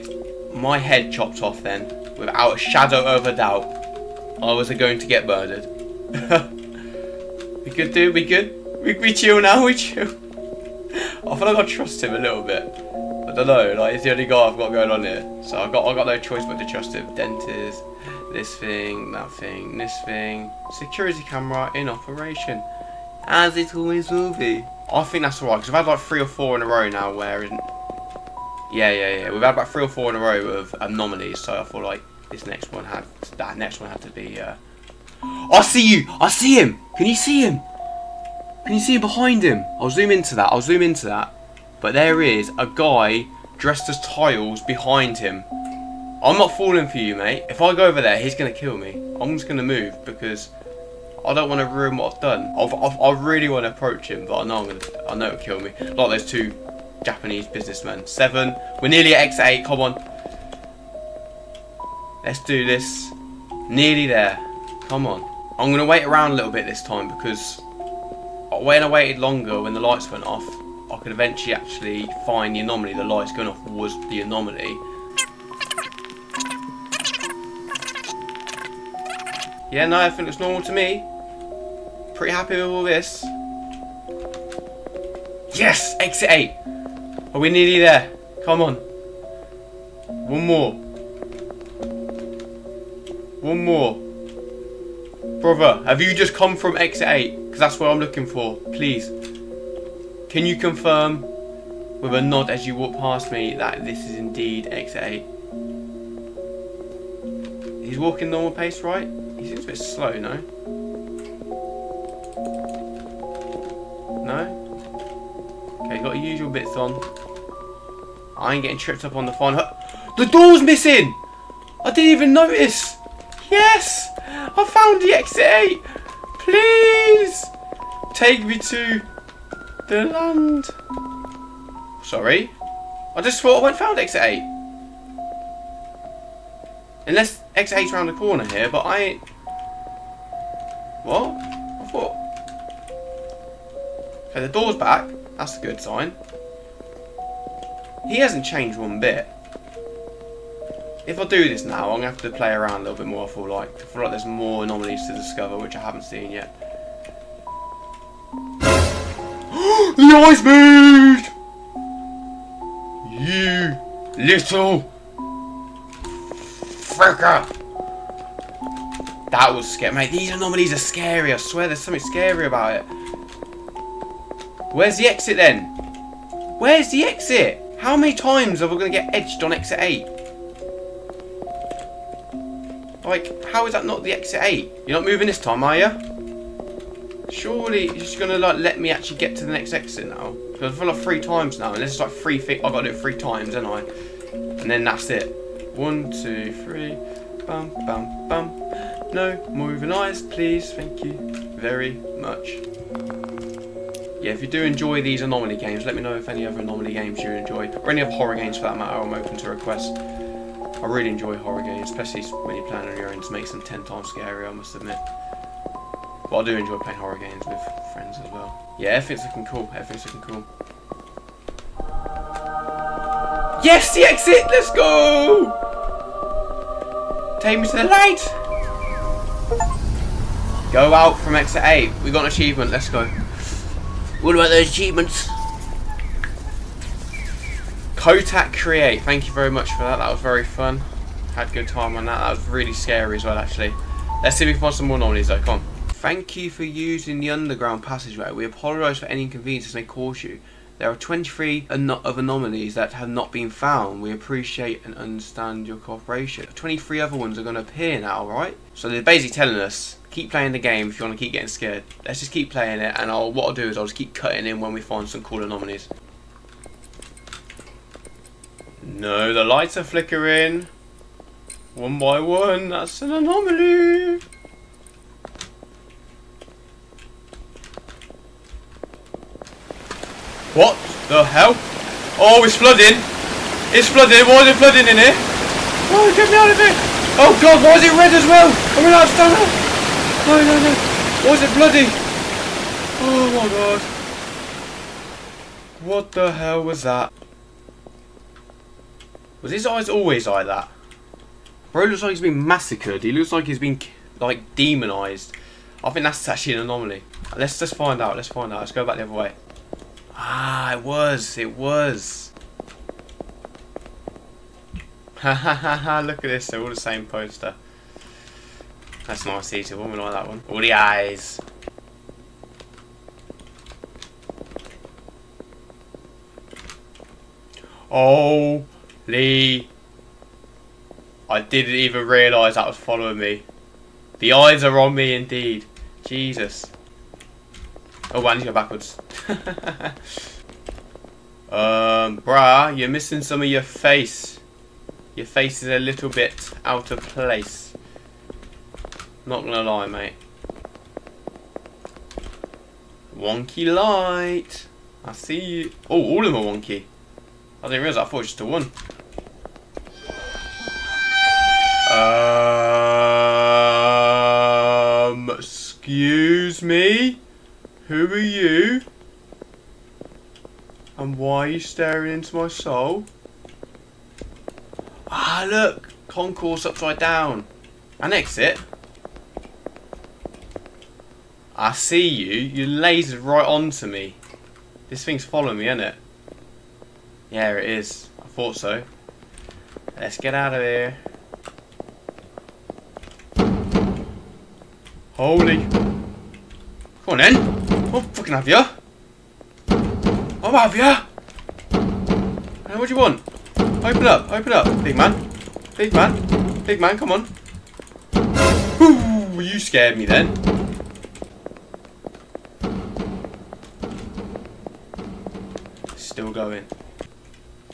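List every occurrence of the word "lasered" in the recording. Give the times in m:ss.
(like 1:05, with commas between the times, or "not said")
6:22.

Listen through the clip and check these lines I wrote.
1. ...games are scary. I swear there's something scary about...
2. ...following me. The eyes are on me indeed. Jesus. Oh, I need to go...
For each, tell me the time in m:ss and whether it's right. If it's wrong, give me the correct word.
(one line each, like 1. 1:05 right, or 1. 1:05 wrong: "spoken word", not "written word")
1. 2:50 wrong: "anomalies", not "games"
2. 5:32 right.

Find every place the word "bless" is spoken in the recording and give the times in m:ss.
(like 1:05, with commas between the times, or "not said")
not said.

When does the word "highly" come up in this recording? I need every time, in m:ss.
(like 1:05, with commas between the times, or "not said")
not said.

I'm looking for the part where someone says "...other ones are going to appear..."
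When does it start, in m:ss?
4:17.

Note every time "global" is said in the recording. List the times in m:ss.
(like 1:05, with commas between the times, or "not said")
not said.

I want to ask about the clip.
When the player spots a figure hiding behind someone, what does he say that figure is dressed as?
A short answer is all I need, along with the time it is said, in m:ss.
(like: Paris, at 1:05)
tiles, at 0:44.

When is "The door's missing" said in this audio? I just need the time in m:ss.
2:00.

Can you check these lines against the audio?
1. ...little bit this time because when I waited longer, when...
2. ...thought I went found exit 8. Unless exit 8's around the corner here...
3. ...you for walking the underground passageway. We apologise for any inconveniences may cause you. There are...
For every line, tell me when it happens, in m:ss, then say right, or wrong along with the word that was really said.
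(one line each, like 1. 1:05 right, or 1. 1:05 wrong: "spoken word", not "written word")
1. 1:06 right
2. 2:13 right
3. 4:06 wrong: "using", not "walking".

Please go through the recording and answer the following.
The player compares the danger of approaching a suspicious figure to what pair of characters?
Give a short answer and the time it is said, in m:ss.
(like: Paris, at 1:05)
two Japanese businessmen, at 0:56.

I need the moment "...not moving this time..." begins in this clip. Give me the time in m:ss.
3:04.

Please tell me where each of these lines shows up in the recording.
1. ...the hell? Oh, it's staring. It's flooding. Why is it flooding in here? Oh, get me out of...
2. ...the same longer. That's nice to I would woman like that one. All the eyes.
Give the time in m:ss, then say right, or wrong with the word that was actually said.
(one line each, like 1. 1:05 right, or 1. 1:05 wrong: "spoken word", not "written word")
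1. 4:41 wrong: "flooding", not "staring"
2. 5:16 wrong: "poster", not "longer".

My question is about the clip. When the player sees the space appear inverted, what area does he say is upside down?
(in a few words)
concourse.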